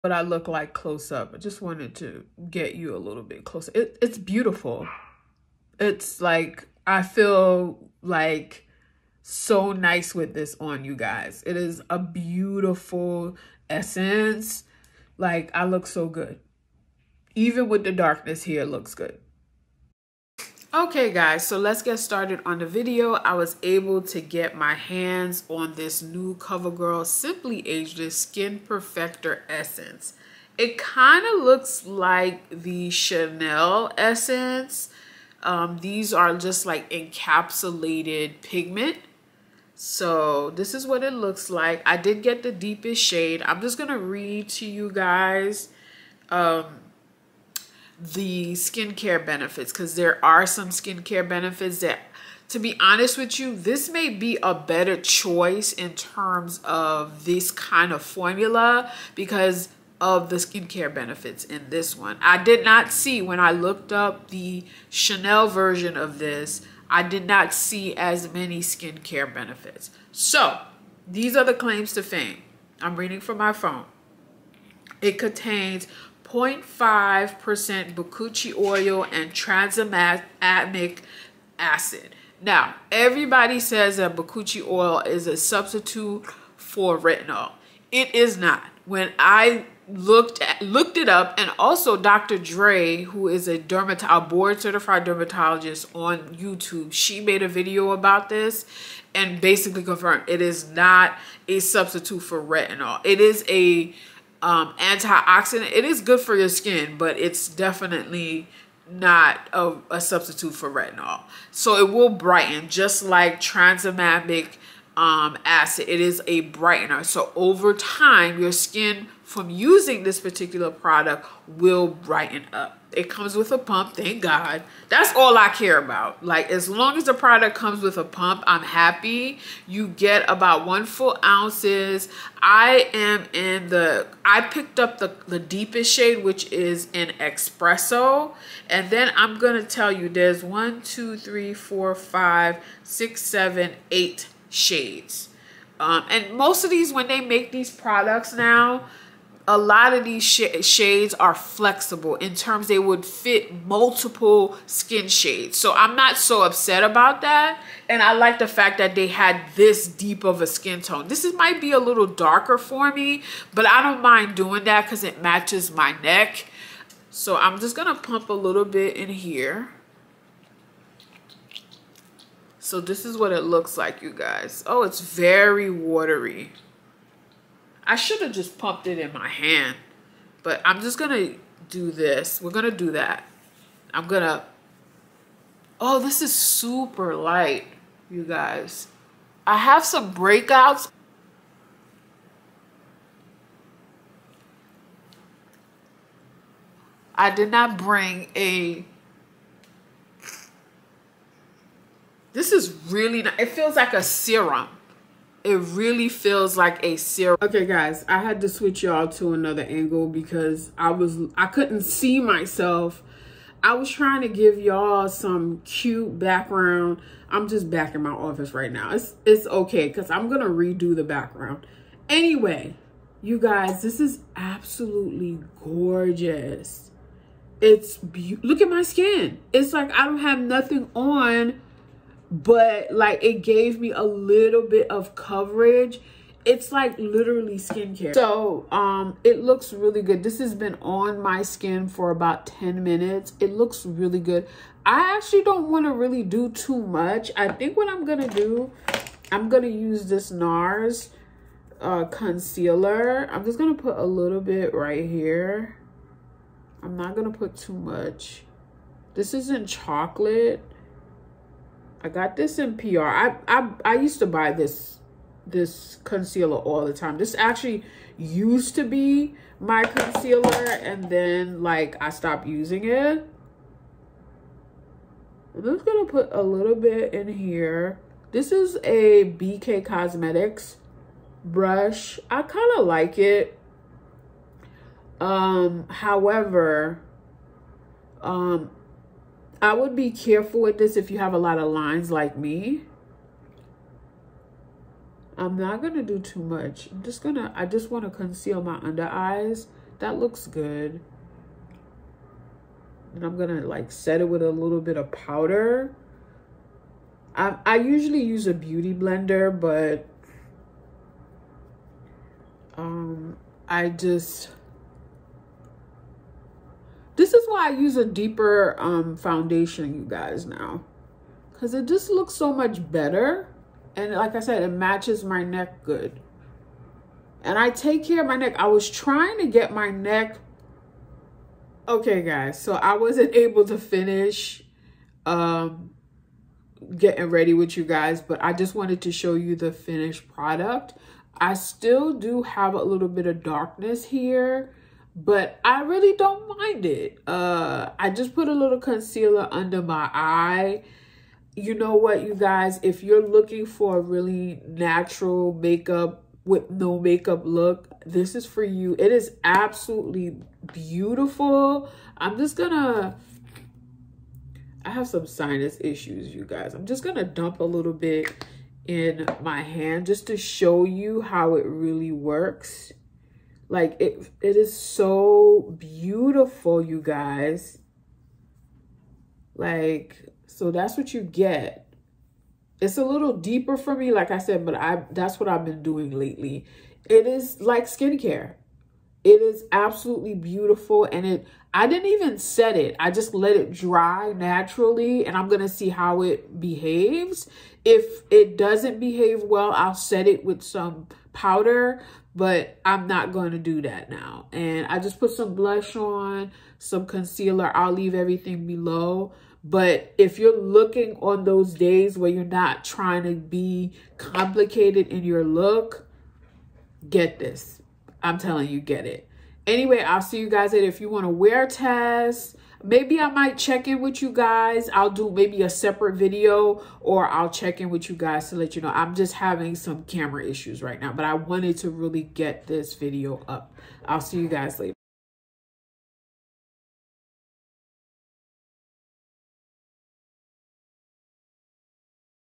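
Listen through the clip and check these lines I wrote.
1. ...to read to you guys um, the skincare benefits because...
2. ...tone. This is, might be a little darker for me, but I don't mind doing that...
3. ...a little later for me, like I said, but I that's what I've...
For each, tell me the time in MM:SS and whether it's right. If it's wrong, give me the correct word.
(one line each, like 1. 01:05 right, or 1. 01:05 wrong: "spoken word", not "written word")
1. 00:43 right
2. 02:40 right
3. 06:22 wrong: "deeper", not "later".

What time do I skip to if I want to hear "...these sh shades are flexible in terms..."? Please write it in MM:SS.
02:30.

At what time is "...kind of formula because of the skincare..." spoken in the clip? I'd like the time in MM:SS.
00:57.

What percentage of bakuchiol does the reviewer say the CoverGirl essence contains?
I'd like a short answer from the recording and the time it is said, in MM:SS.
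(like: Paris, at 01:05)
0.5%, at 01:16.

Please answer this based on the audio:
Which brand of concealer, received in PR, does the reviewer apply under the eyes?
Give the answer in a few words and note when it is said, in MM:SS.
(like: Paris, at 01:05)
NARS, at 04:10.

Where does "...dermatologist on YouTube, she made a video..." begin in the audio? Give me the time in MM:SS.
01:35.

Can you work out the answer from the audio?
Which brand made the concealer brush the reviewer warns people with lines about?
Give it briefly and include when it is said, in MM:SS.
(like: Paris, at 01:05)
BK Cosmetics, at 04:39.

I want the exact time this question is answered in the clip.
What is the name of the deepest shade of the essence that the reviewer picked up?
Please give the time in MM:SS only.
02:16.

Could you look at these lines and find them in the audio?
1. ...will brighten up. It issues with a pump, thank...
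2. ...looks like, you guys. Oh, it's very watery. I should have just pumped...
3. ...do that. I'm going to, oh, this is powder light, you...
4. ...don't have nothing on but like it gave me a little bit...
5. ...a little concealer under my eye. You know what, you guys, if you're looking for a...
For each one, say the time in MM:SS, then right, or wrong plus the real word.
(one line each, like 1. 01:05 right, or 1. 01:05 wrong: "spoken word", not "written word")
1. 02:01 wrong: "comes", not "issues"
2. 02:53 right
3. 03:02 wrong: "super", not "powder"
4. 03:50 right
5. 05:48 right.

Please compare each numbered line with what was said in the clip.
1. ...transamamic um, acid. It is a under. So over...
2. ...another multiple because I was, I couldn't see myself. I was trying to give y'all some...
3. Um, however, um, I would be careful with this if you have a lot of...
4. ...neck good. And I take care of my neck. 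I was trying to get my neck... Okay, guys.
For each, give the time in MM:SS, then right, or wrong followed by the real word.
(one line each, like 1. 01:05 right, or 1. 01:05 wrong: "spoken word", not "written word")
1. 01:53 wrong: "brightener", not "under"
2. 03:29 wrong: "angle", not "multiple"
3. 04:45 right
4. 05:25 right.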